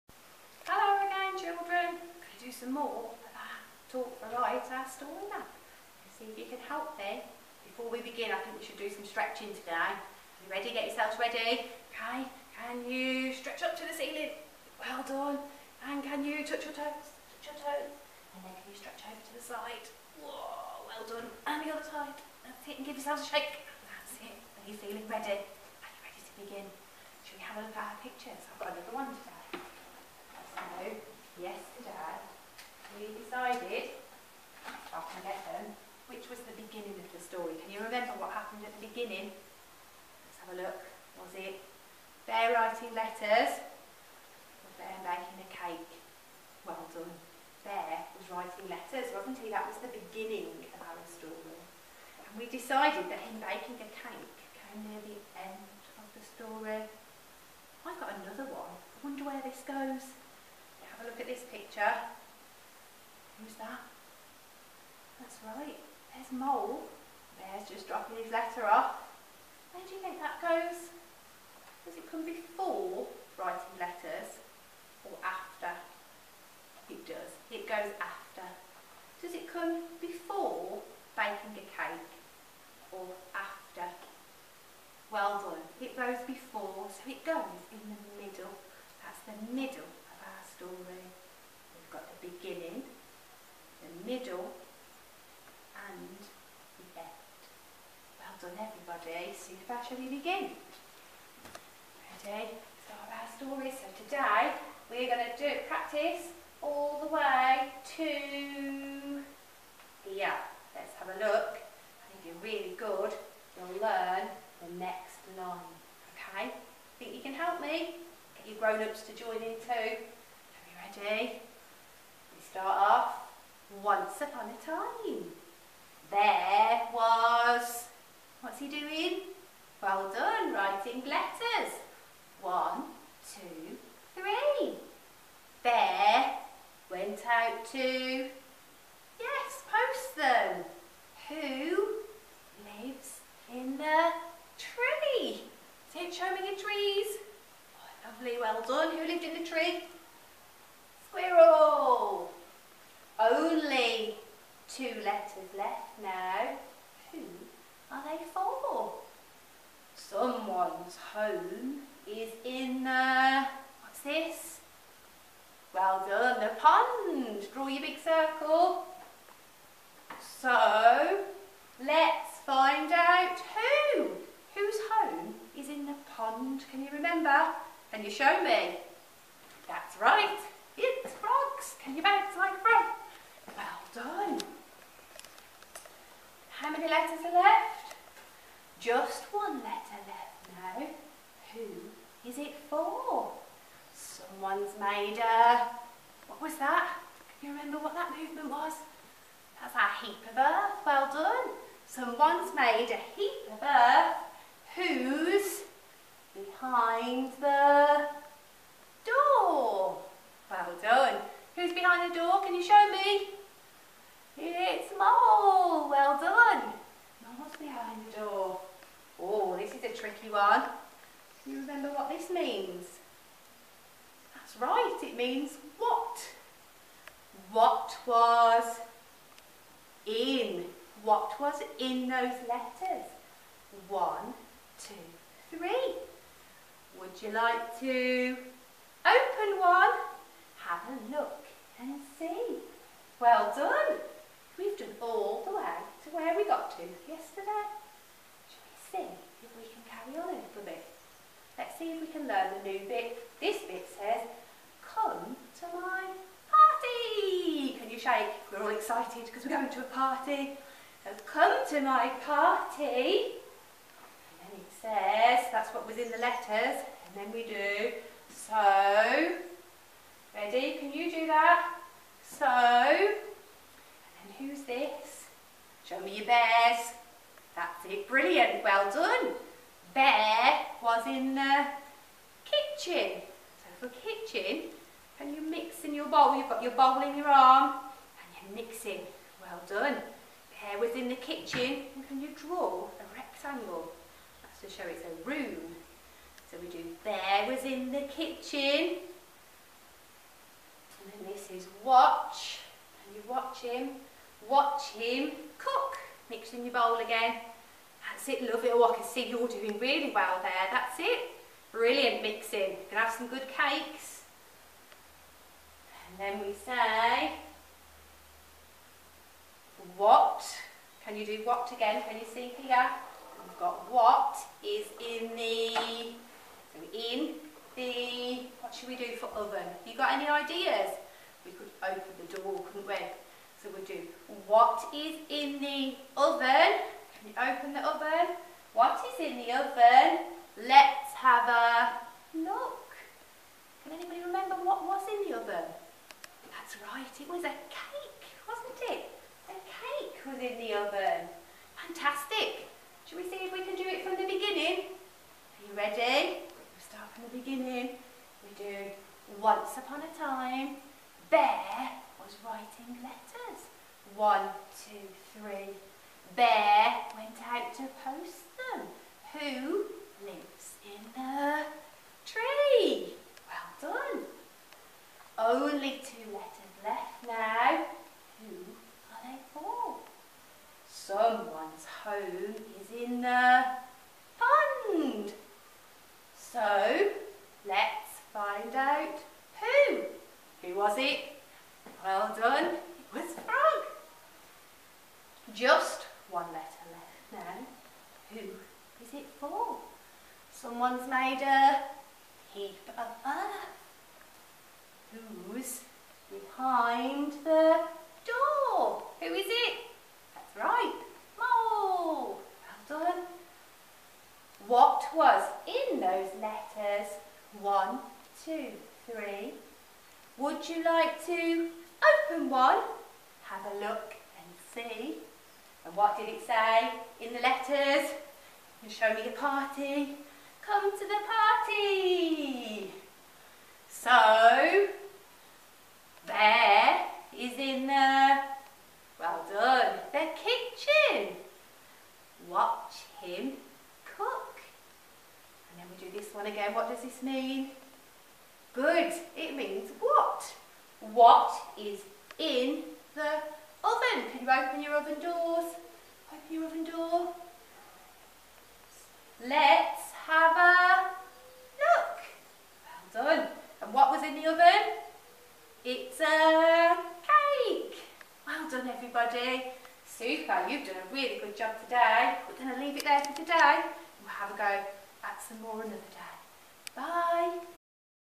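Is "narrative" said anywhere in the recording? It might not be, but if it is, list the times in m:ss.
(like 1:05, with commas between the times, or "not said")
not said.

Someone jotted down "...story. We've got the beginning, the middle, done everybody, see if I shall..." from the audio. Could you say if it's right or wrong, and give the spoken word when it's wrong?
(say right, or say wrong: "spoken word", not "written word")
right.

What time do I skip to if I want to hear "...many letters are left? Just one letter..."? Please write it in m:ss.
3:06.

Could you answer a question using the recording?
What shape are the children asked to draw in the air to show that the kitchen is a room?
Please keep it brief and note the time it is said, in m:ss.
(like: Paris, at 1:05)
A rectangle, at 4:52.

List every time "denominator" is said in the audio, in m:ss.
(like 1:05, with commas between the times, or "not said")
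not said.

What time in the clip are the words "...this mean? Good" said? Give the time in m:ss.
7:27.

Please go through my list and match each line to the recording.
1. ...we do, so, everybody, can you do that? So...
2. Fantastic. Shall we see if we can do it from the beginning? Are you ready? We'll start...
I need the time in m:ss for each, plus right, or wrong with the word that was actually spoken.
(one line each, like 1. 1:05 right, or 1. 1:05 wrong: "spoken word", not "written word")
1. 4:27 wrong: "ready", not "everybody"
2. 5:51 right.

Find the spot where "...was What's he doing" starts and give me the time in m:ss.
2:06.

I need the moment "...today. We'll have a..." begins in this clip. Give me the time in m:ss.
7:53.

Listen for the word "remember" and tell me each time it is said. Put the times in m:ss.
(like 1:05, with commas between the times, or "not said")
2:56, 3:17, 3:41, 5:44.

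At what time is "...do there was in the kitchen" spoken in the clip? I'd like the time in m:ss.
4:56.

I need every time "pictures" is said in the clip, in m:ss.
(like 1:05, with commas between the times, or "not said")
0:28, 1:01.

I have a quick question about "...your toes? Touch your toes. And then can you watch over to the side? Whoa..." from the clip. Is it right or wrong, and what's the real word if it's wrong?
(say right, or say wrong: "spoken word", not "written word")
wrong: "stretch", not "watch".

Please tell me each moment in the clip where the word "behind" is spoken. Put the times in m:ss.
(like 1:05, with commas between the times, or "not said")
3:26, 3:31, 3:37, 6:46.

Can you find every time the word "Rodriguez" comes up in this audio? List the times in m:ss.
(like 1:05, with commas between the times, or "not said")
not said.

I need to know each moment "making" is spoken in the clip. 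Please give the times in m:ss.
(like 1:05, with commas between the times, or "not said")
0:45.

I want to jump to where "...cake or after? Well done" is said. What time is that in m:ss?
1:21.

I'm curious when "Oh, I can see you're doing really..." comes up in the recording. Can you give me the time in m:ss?
5:08.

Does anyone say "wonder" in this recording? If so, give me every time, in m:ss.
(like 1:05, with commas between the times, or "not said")
0:59.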